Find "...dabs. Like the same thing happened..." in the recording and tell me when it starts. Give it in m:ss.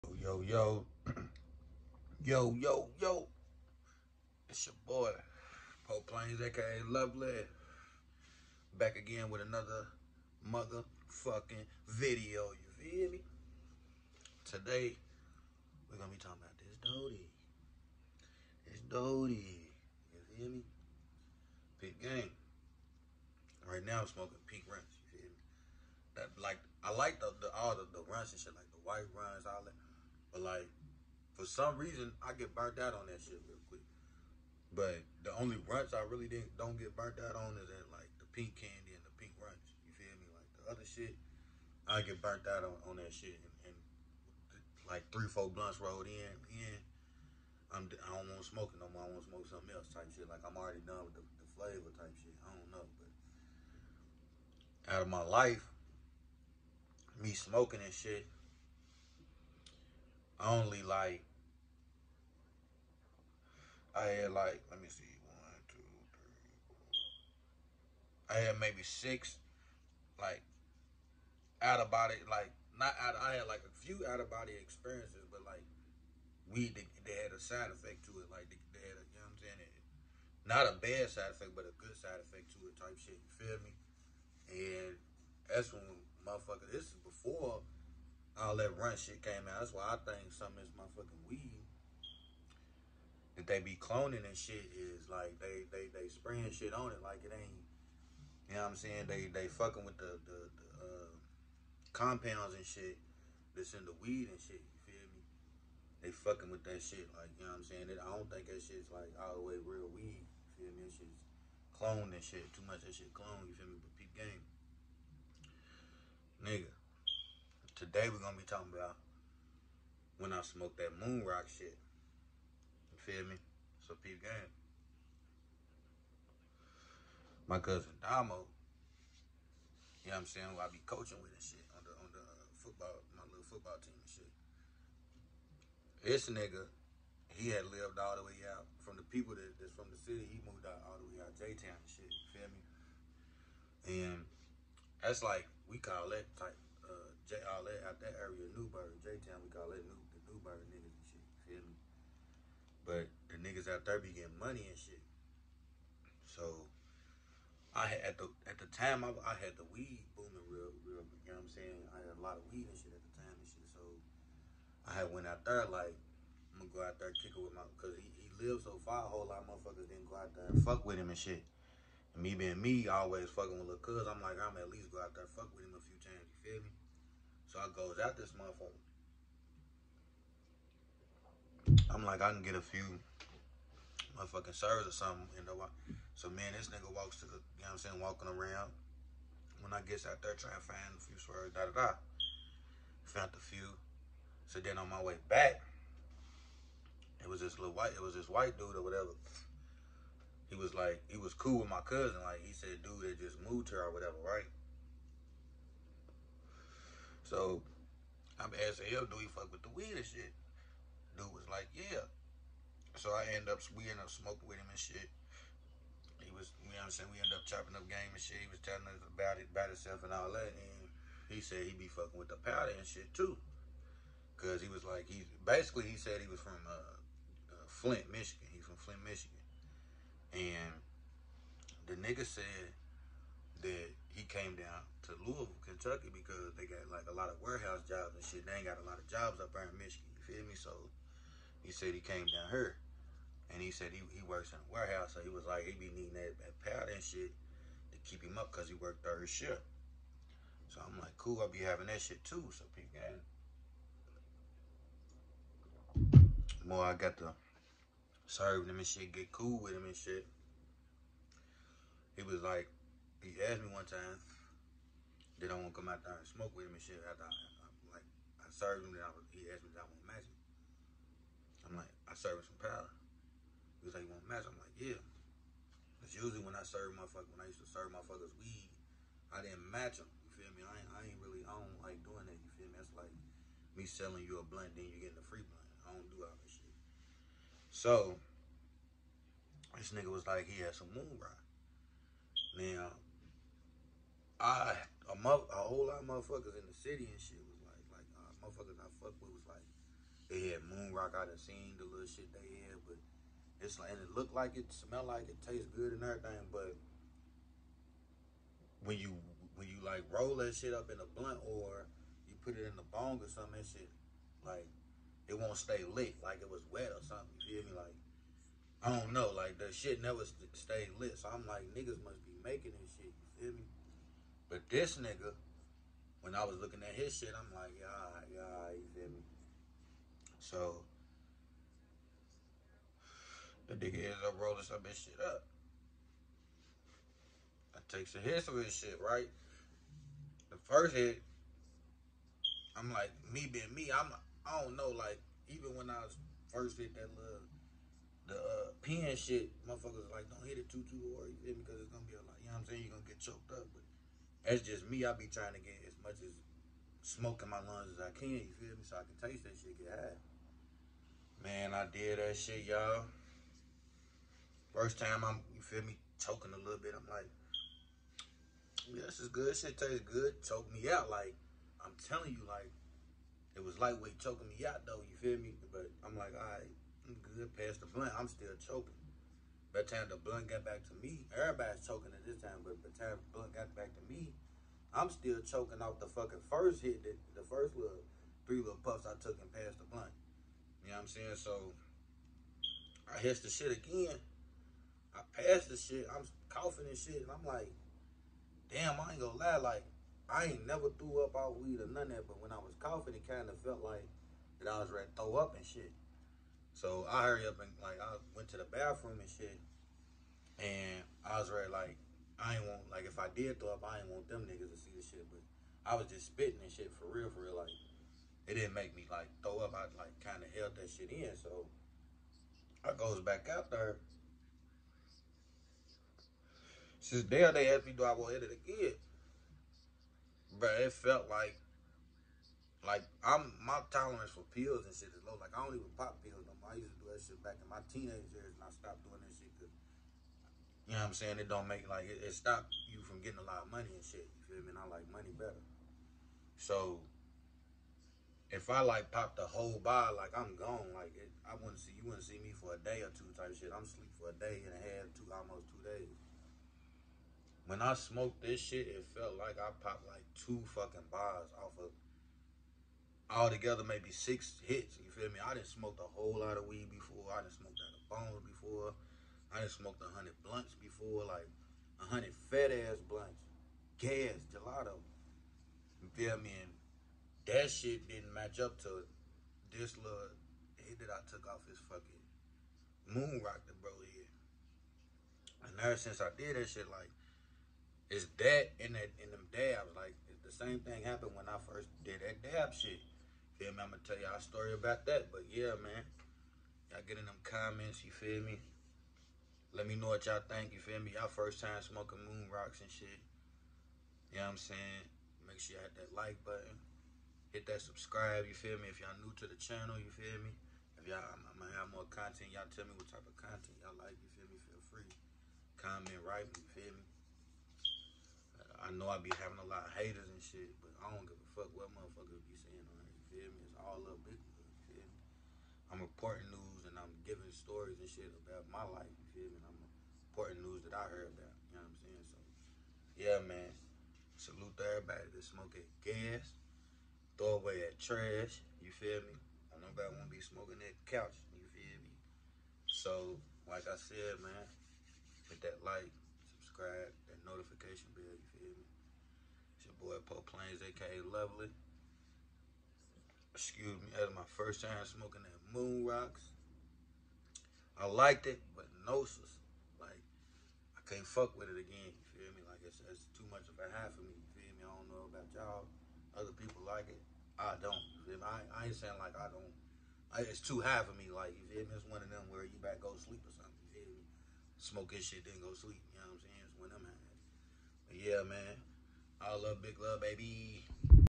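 8:09.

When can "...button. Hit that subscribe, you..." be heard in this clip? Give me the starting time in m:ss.
8:26.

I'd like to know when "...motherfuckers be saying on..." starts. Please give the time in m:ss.
8:41.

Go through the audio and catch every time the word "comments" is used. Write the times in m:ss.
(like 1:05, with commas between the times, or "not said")
8:17, 8:35.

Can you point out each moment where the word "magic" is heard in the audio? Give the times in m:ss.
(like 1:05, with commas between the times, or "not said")
4:30, 4:34.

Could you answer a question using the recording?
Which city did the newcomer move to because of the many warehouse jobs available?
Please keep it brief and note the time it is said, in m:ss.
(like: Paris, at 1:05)
Louisville, Kentucky, at 3:55.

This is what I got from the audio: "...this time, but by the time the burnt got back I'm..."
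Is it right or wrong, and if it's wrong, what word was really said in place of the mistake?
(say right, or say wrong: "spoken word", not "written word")
wrong: "blunt", not "burnt".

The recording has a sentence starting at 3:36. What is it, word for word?
He was, you know what I'm saying, we end up chopping up game and shit.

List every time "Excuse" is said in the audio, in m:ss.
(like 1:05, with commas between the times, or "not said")
9:13.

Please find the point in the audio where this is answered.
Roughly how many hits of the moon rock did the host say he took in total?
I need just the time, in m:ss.
7:44.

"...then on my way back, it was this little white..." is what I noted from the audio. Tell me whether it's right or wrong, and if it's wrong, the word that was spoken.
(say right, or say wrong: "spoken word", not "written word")
right.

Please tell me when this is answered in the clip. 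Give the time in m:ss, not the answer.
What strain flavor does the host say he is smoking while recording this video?
0:24.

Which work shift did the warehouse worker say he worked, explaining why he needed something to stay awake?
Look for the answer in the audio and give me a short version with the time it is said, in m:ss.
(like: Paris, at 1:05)
Third shift, at 4:09.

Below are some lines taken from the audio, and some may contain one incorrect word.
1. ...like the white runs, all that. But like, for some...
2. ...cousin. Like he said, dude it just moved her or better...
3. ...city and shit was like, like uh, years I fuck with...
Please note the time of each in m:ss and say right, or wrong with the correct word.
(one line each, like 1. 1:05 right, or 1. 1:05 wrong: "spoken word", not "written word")
1. 0:28 right
2. 3:21 wrong: "whatever", not "better"
3. 4:56 wrong: "motherfuckers", not "years".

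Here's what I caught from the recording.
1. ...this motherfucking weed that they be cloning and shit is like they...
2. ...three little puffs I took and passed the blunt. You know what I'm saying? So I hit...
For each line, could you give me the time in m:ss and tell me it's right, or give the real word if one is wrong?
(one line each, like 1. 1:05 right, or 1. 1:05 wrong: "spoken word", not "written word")
1. 1:30 right
2. 6:28 right.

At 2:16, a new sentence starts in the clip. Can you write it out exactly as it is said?
This nigga, he had lived all the way out from the people that, that's from the city.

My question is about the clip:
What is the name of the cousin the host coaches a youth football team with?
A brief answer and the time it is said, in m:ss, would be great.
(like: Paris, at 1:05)
Damo, at 2:07.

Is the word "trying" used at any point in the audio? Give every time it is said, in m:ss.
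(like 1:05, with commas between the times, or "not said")
3:10, 5:55.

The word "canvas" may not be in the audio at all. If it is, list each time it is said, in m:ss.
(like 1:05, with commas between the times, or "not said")
not said.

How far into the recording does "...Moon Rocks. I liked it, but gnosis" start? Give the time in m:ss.
9:15.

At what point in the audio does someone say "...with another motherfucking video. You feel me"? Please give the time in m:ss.
0:09.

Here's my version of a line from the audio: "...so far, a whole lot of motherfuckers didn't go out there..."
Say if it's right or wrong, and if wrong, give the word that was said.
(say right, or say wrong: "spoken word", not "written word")
right.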